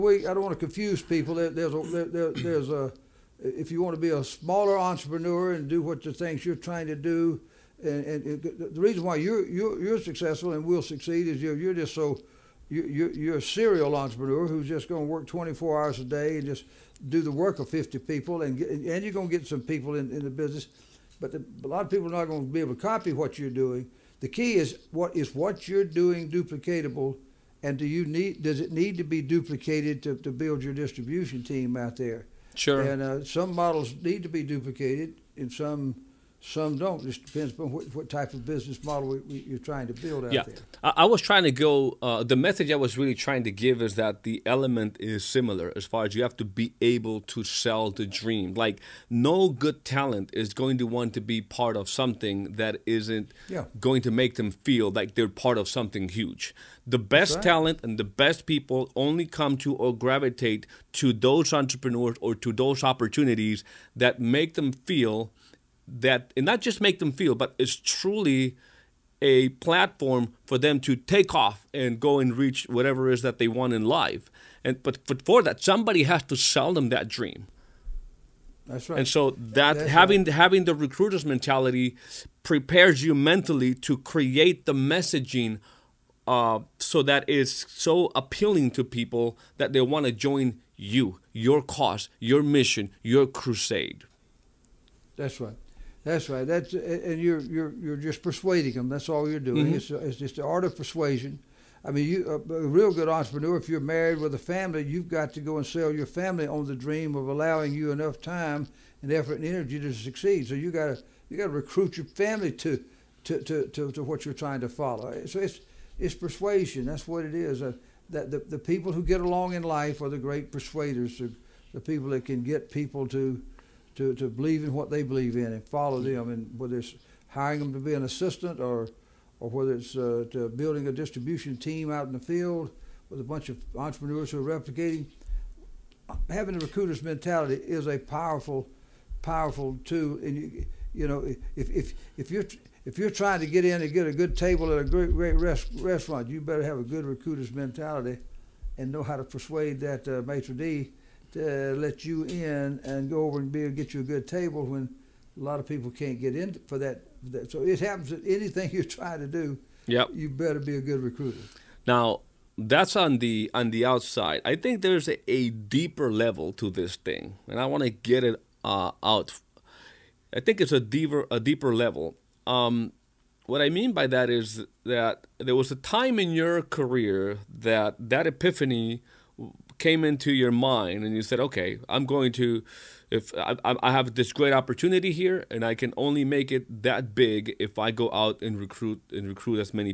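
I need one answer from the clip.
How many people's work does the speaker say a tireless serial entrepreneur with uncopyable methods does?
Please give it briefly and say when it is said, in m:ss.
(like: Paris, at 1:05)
50, at 0:17.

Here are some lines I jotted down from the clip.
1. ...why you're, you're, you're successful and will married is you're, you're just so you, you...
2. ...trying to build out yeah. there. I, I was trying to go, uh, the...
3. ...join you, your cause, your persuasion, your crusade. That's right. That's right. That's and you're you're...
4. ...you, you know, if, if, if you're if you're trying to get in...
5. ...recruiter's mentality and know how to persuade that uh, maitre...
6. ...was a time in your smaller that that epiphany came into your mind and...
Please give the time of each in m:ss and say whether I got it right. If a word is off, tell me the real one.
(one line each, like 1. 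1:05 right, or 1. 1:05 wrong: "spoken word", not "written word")
1. 0:09 wrong: "succeed", not "married"
2. 0:39 right
3. 1:30 wrong: "mission", not "persuasion"
4. 2:20 right
5. 2:27 right
6. 2:55 wrong: "career", not "smaller".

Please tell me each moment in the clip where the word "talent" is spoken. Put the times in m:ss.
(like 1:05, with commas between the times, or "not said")
0:49, 0:57.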